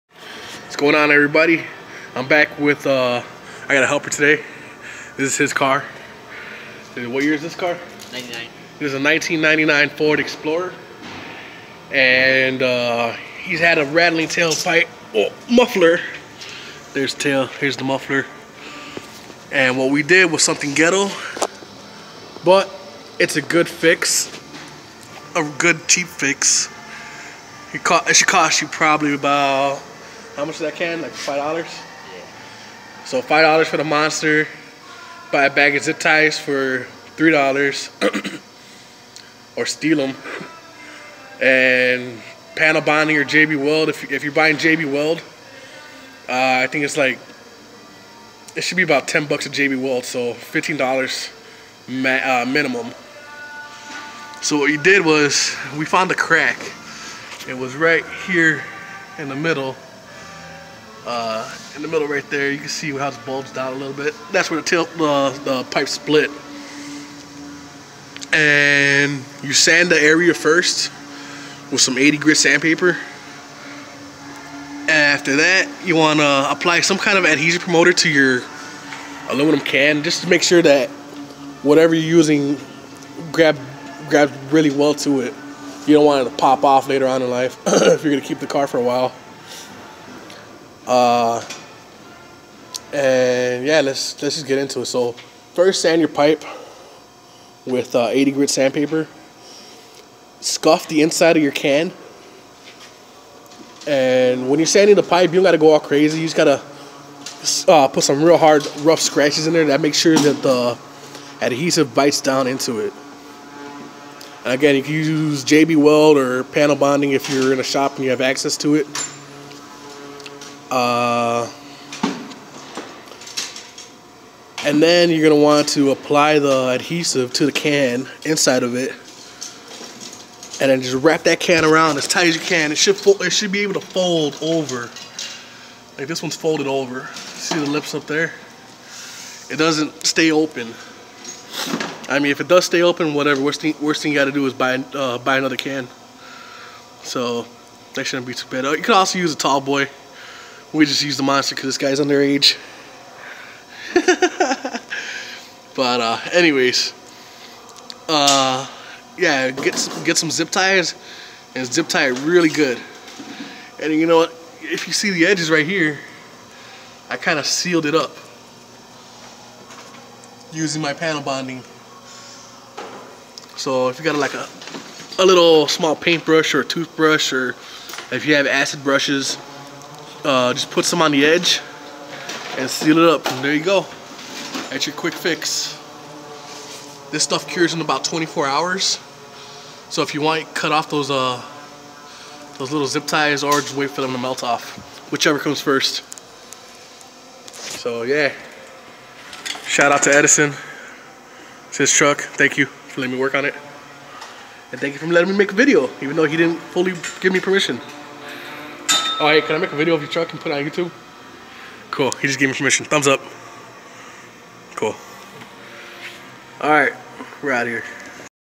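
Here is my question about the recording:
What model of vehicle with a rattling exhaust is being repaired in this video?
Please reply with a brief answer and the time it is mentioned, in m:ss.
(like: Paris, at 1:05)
Ford Explorer, at 0:09.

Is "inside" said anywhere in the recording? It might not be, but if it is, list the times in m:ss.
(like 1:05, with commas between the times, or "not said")
1:41, 2:08.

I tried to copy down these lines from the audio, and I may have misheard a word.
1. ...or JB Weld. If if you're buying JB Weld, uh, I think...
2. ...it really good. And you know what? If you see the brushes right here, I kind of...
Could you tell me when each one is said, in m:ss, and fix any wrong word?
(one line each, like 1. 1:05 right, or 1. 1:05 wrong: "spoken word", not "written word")
1. 0:43 right
2. 2:42 wrong: "edges", not "brushes".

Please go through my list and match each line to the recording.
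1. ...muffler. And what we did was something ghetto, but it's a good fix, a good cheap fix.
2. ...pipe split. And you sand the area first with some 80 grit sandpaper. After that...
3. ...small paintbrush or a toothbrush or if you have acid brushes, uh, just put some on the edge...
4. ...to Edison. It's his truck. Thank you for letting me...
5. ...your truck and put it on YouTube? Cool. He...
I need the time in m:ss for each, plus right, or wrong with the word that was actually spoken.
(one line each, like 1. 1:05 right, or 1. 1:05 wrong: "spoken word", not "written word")
1. 0:17 right
2. 1:05 right
3. 2:55 right
4. 3:20 right
5. 3:30 right.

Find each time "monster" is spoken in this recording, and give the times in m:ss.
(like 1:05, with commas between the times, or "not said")
0:33, 2:31.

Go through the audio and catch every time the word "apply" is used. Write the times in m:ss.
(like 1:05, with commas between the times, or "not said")
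1:16, 2:05.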